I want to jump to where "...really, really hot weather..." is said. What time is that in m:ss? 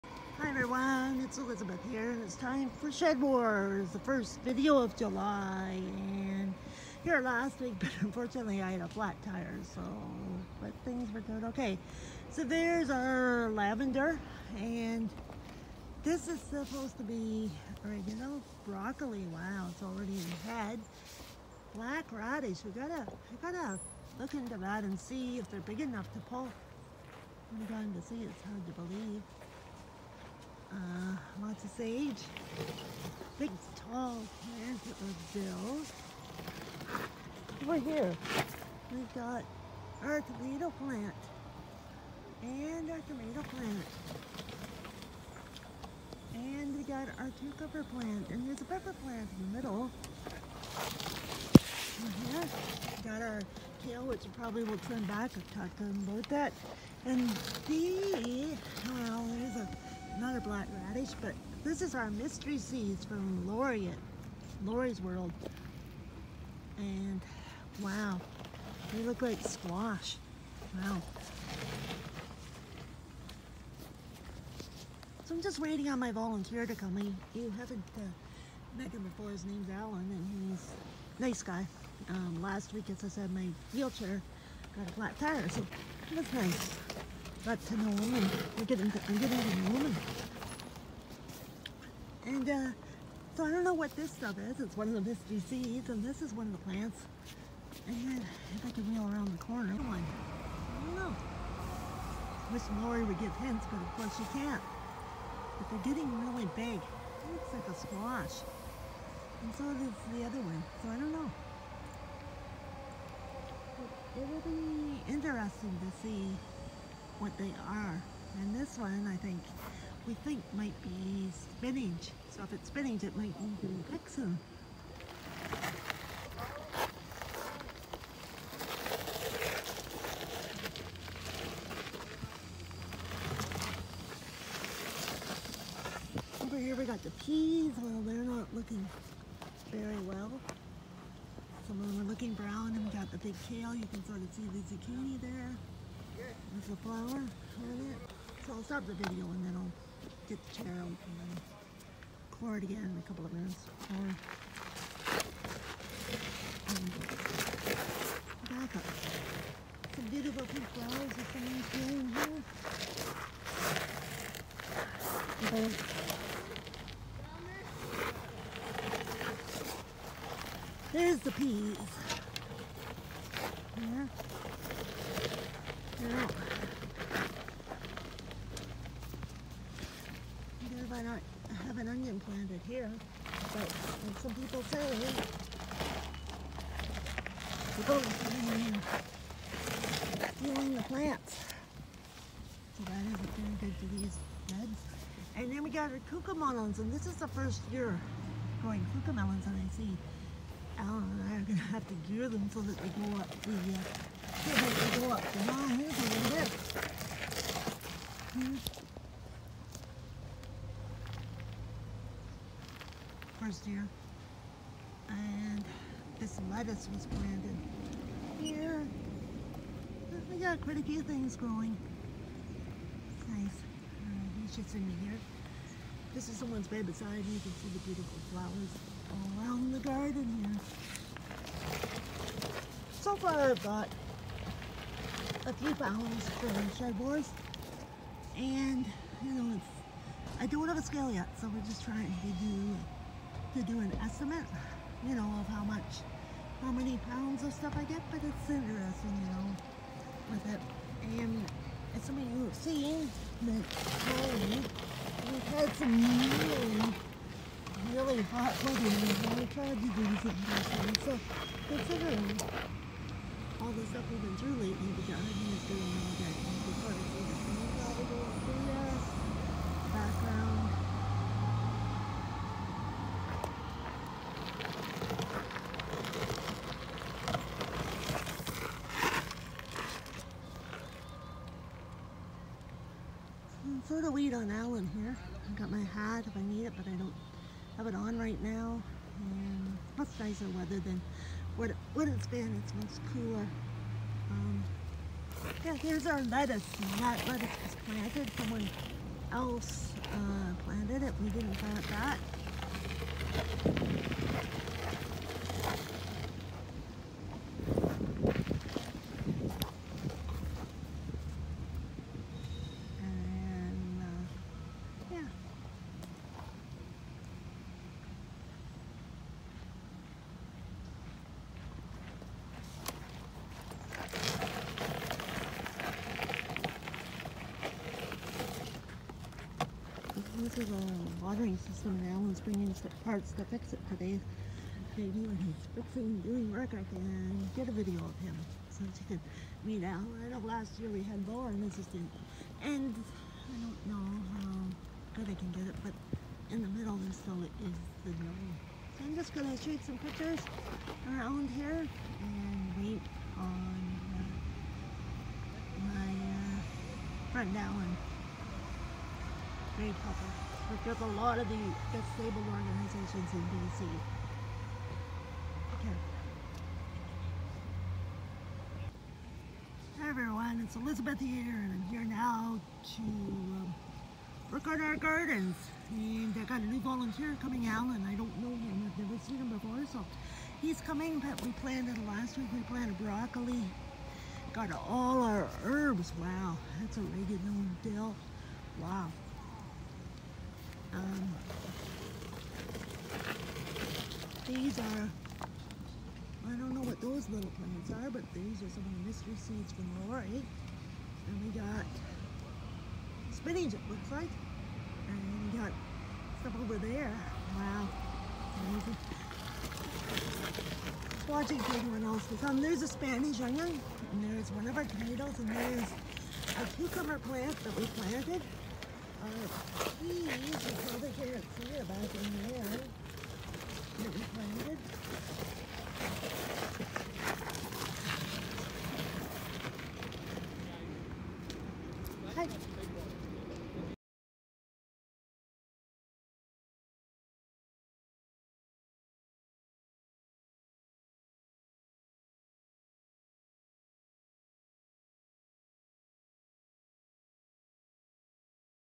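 4:15.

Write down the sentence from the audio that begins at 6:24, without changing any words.
Got all our herbs, wow, that's oregano and dill, wow.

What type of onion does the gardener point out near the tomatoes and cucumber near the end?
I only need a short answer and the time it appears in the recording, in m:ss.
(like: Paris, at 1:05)
Spanish onion, at 6:52.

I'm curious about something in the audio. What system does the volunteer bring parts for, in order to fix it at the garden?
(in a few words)
watering system.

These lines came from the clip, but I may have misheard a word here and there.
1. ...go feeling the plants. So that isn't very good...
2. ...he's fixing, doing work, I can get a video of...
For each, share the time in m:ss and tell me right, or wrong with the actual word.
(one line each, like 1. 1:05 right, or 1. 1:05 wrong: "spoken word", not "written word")
1. 3:07 right
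2. 5:35 right.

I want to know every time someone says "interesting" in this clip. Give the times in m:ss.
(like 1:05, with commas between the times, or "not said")
1:55, 4:08.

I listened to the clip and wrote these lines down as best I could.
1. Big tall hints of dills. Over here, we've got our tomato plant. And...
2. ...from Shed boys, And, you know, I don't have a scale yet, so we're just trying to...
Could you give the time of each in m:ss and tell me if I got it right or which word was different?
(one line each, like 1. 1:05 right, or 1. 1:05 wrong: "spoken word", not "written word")
1. 0:33 wrong: "plants", not "hints"
2. 3:56 right.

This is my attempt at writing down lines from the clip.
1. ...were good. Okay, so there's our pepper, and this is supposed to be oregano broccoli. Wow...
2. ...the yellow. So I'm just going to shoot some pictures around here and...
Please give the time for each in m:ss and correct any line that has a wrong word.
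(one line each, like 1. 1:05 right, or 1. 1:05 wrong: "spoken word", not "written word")
1. 0:11 wrong: "lavender", not "pepper"
2. 5:48 right.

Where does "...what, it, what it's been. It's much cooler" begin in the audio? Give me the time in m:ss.
4:51.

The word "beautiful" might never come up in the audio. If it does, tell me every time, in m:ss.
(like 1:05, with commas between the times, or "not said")
2:40, 3:47.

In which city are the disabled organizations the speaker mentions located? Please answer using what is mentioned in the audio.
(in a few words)
D.C.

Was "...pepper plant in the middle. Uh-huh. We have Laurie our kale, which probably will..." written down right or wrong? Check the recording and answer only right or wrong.
wrong.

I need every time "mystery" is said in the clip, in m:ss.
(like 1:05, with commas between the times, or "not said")
1:02, 6:39.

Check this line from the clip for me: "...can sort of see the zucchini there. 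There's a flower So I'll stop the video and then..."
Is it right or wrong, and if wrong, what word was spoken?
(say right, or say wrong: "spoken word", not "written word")
right.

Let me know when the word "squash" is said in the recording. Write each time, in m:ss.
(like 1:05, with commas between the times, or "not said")
1:09, 1:47.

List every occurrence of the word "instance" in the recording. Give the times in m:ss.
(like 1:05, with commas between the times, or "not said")
not said.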